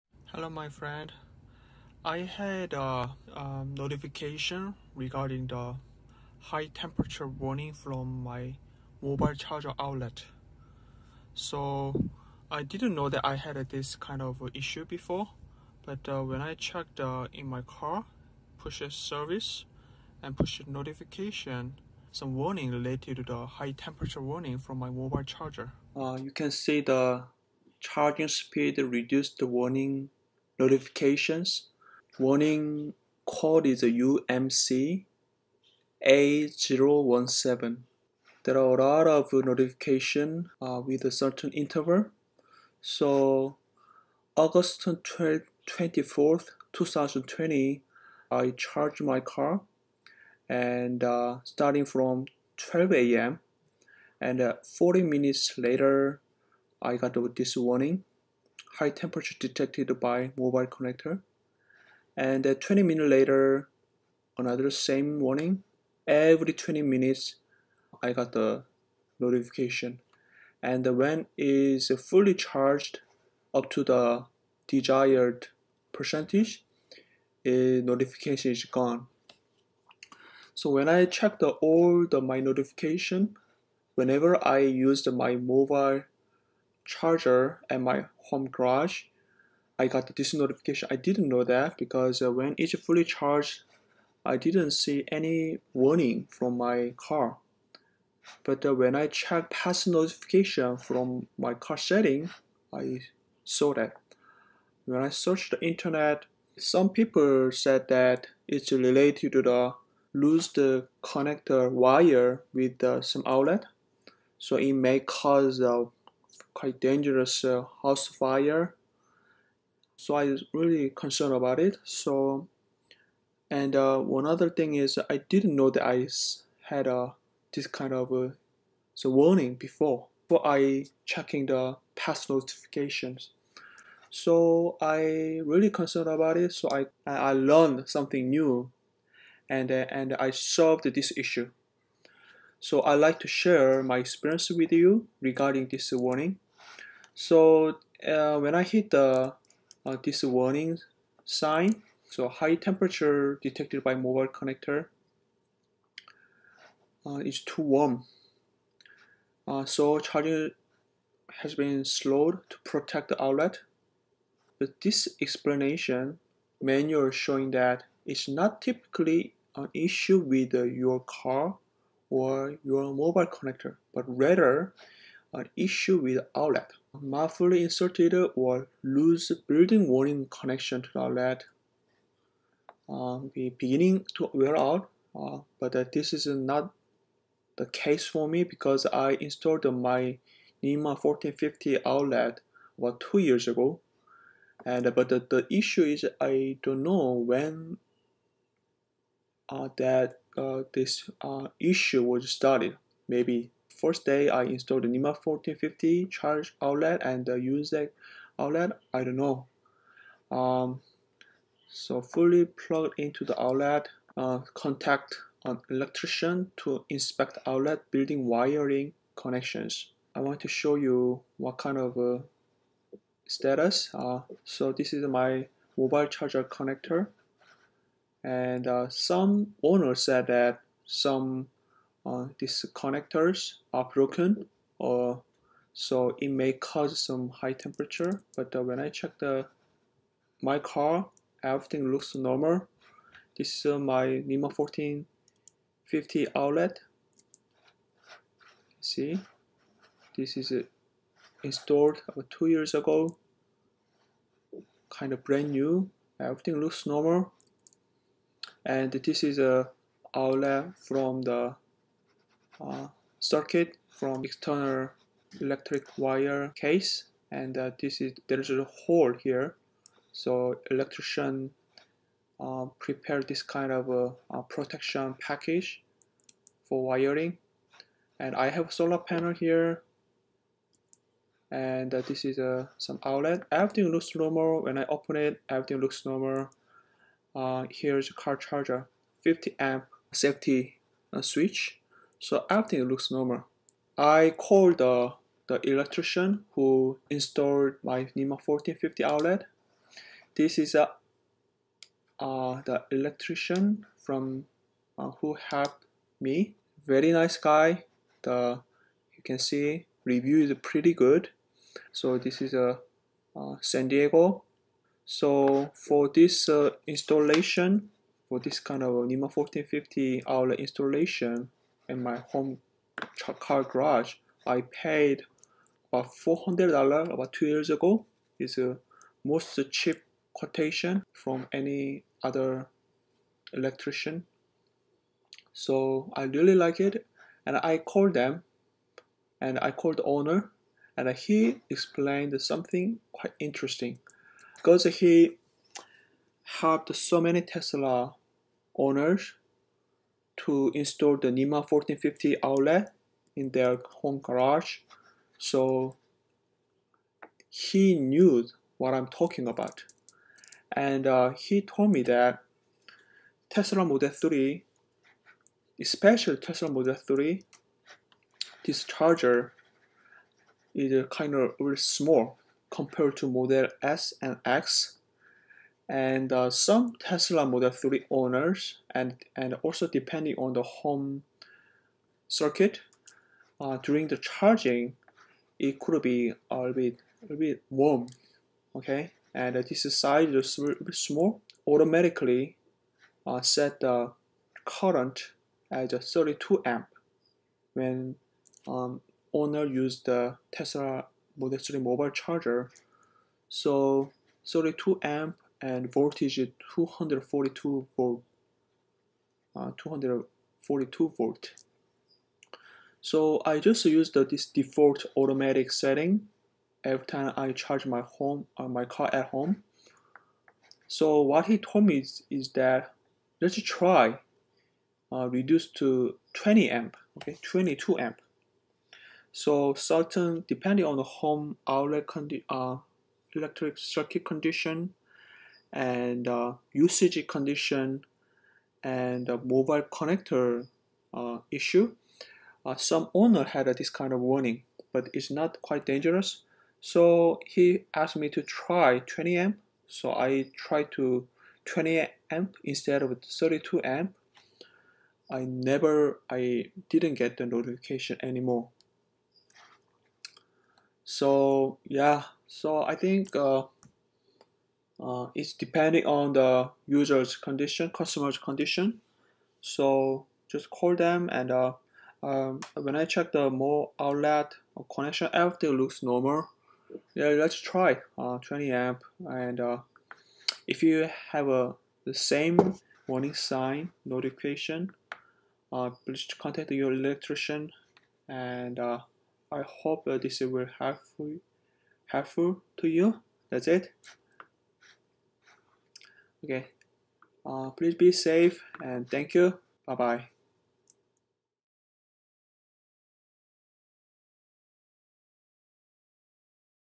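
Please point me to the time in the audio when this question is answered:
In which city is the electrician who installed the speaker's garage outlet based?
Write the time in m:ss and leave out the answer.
5:13.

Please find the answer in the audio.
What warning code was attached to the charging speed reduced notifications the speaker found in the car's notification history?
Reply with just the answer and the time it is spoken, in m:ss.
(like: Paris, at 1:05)
UMC A017, at 0:34.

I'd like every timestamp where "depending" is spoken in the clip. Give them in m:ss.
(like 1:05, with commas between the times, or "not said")
6:19, 7:10, 7:45.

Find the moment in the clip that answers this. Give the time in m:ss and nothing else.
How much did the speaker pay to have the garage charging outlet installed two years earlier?
5:26.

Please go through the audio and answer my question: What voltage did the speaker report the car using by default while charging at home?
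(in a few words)
242 volts.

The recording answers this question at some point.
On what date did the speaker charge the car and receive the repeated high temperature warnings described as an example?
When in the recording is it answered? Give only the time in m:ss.
0:44.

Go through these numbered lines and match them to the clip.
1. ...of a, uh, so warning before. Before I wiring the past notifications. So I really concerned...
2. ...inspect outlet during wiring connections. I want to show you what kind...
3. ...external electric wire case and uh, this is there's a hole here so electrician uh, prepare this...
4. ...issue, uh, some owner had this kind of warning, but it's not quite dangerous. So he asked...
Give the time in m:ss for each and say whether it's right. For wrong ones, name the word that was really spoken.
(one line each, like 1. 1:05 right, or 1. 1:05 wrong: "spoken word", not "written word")
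1. 2:07 wrong: "checking", not "wiring"
2. 3:36 wrong: "building", not "during"
3. 4:24 right
4. 7:21 right.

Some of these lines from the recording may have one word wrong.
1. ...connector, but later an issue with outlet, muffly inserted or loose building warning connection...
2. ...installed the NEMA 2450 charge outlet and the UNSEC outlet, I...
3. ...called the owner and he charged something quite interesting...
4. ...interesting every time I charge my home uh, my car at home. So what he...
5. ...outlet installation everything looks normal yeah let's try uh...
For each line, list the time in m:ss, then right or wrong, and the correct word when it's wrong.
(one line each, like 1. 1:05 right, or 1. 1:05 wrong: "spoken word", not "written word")
1. 2:53 wrong: "rather", not "later"
2. 3:24 wrong: "1450", not "2450"
3. 5:39 wrong: "explained", not "charged"
4. 6:55 wrong: "setting", not "interesting"
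5. 7:53 wrong: "connection", not "installation".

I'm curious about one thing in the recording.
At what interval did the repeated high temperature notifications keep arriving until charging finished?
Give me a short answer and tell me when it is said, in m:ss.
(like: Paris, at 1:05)
Every 20 minutes, at 1:06.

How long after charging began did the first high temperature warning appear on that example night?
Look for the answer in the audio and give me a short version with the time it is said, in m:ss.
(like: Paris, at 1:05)
40 minutes, at 0:54.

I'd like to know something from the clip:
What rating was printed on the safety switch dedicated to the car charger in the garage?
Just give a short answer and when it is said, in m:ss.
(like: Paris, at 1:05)
50 amp, at 4:49.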